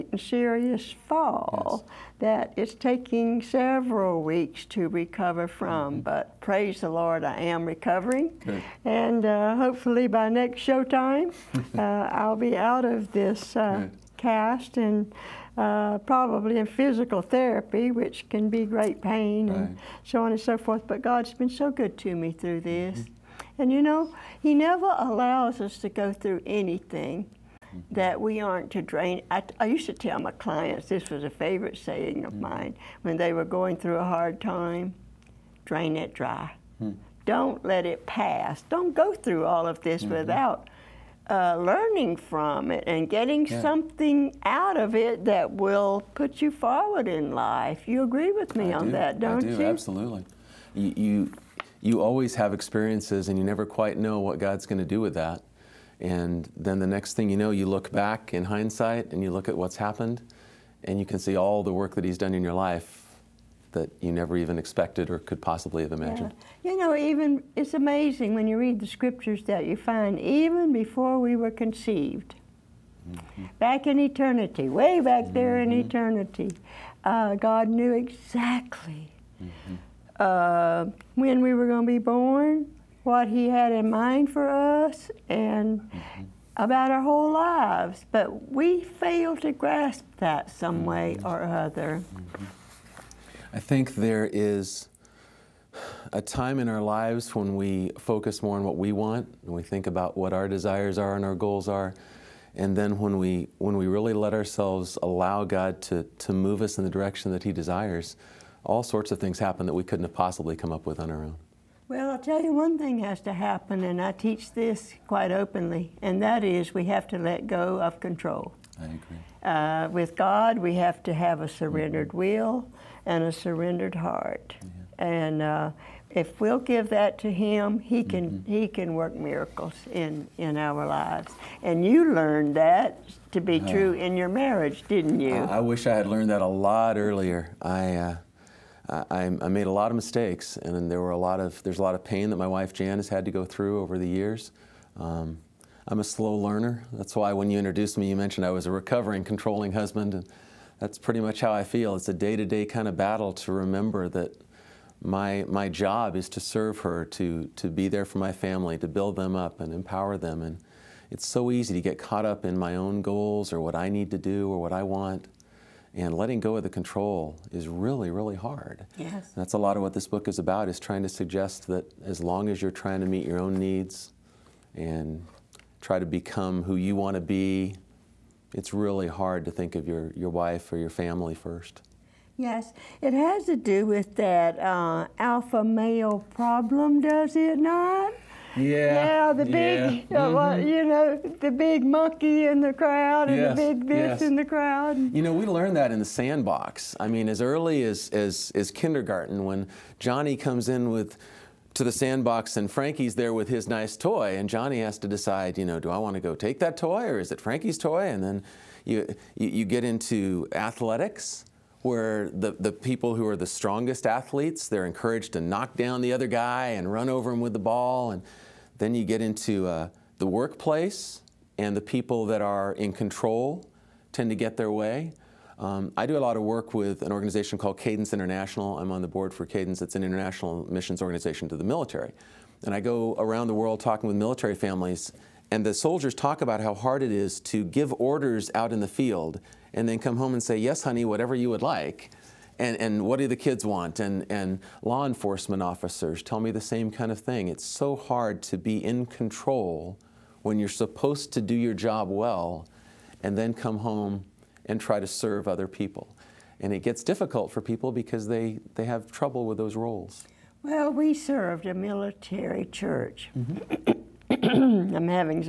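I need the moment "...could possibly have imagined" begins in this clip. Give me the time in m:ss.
1:05.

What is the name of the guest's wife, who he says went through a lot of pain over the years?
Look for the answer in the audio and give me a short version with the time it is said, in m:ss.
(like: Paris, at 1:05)
Jan, at 2:22.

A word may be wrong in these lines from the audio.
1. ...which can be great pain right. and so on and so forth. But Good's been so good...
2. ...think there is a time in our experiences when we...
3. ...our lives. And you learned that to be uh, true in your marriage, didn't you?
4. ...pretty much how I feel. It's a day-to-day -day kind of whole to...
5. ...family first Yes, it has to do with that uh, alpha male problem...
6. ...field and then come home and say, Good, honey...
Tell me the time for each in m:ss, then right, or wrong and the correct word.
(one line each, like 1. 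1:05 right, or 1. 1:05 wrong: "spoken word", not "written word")
1. 0:17 wrong: "God", not "Good"
2. 1:33 wrong: "lives", not "experiences"
3. 2:10 right
4. 2:30 wrong: "battle", not "whole"
5. 3:00 right
6. 3:58 wrong: "Yes", not "Good".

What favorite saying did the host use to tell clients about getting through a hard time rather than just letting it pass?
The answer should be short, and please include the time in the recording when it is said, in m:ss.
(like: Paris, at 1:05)
Drain it dry, at 0:35.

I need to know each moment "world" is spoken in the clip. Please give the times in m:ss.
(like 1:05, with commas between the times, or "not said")
3:53.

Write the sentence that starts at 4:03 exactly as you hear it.
And, and law enforcement officers tell me the same kind of thing.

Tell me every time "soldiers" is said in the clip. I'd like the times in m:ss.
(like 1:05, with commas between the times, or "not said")
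3:55.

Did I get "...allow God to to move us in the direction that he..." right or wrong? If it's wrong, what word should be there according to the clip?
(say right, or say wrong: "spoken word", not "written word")
right.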